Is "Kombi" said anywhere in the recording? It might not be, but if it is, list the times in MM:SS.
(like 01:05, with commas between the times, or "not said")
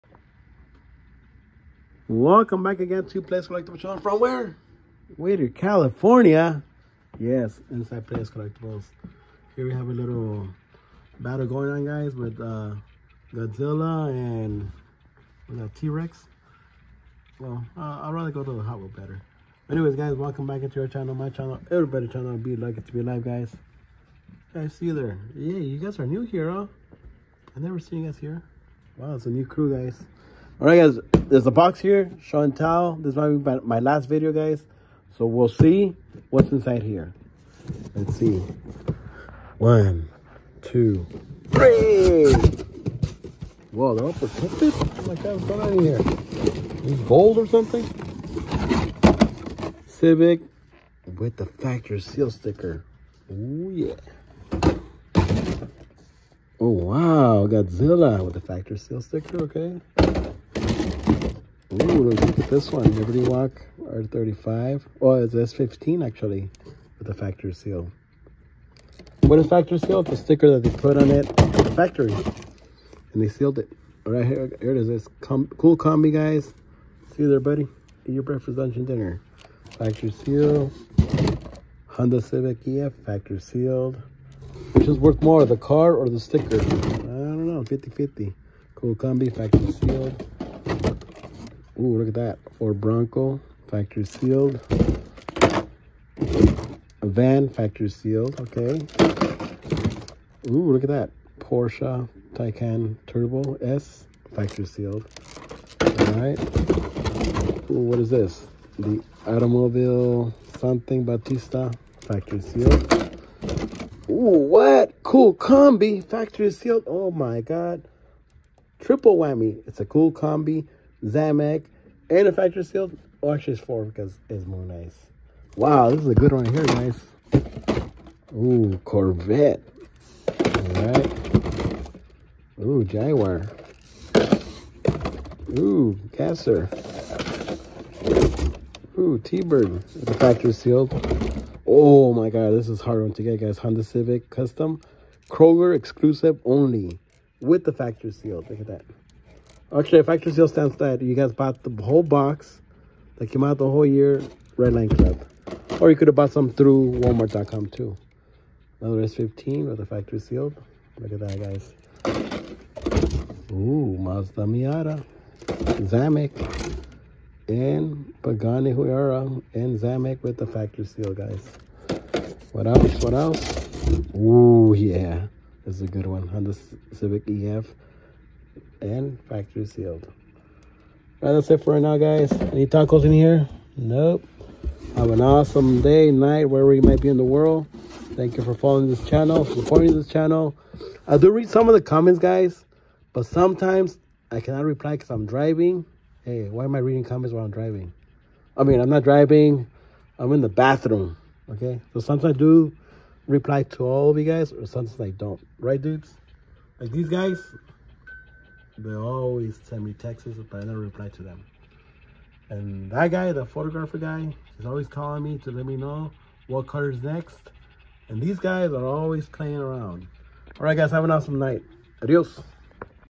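01:15, 01:28, 01:55, 02:00.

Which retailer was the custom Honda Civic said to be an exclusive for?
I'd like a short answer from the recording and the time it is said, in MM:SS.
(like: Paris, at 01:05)
Kroger, at 02:25.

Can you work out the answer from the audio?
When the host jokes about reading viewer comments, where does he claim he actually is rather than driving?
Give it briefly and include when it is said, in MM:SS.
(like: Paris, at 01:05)
In the bathroom, at 03:20.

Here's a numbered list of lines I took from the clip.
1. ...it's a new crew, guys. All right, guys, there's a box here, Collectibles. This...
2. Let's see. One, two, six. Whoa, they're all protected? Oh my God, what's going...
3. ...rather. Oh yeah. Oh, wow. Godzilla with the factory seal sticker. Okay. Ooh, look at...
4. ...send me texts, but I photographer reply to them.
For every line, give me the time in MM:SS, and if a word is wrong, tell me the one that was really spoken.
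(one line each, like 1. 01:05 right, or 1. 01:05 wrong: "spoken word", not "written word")
1. 00:29 wrong: "Chantal", not "Collectibles"
2. 00:37 wrong: "three", not "six"
3. 00:52 wrong: "sticker", not "rather"
4. 03:29 wrong: "never", not "photographer".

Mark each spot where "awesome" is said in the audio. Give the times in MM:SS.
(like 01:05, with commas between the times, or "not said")
03:05, 03:41.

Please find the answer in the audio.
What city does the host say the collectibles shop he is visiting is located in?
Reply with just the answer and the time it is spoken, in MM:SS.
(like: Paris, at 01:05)
Whittier, California, at 00:05.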